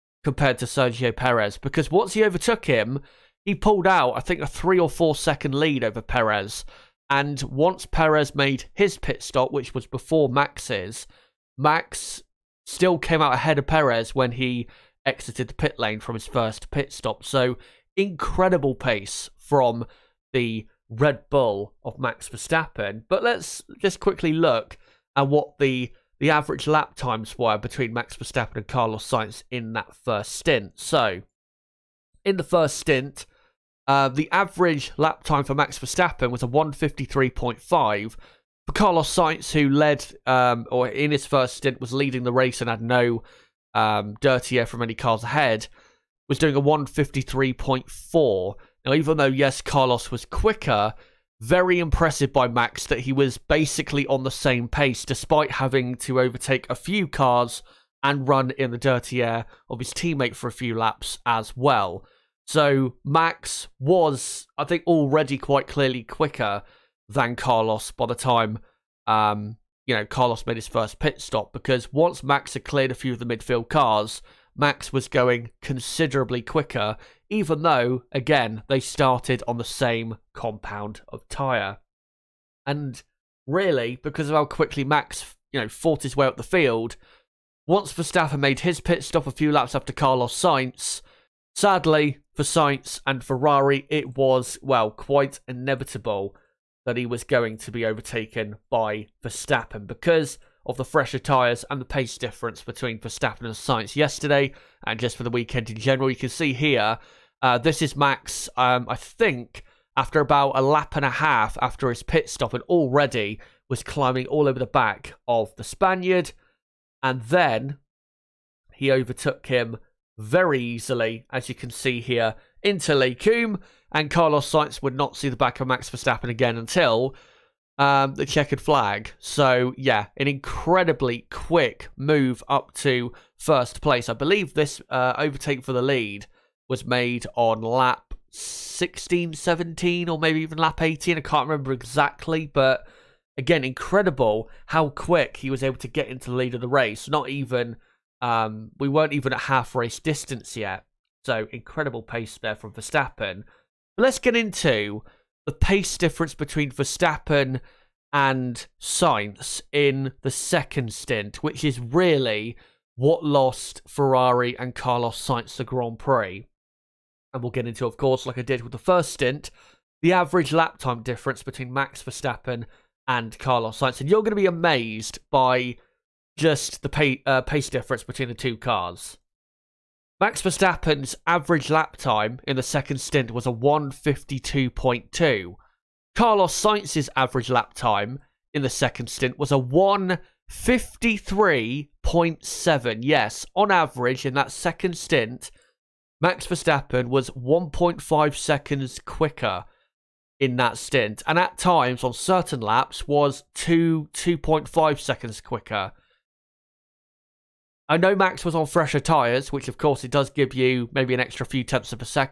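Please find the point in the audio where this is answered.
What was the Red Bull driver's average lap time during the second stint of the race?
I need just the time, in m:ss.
3:03.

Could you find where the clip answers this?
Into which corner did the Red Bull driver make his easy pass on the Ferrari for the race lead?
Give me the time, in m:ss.
2:02.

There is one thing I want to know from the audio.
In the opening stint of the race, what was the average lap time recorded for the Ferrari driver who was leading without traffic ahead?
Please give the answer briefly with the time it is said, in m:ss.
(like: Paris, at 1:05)
1:53.4, at 0:46.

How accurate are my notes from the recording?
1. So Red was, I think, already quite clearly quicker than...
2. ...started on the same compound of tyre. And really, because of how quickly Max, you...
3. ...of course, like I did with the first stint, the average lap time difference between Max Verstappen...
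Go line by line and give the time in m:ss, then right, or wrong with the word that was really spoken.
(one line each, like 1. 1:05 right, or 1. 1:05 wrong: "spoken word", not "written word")
1. 1:02 wrong: "Max", not "Red"
2. 1:18 right
3. 2:47 right.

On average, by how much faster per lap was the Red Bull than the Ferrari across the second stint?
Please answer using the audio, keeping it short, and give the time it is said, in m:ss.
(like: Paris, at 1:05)
1.5 seconds, at 3:17.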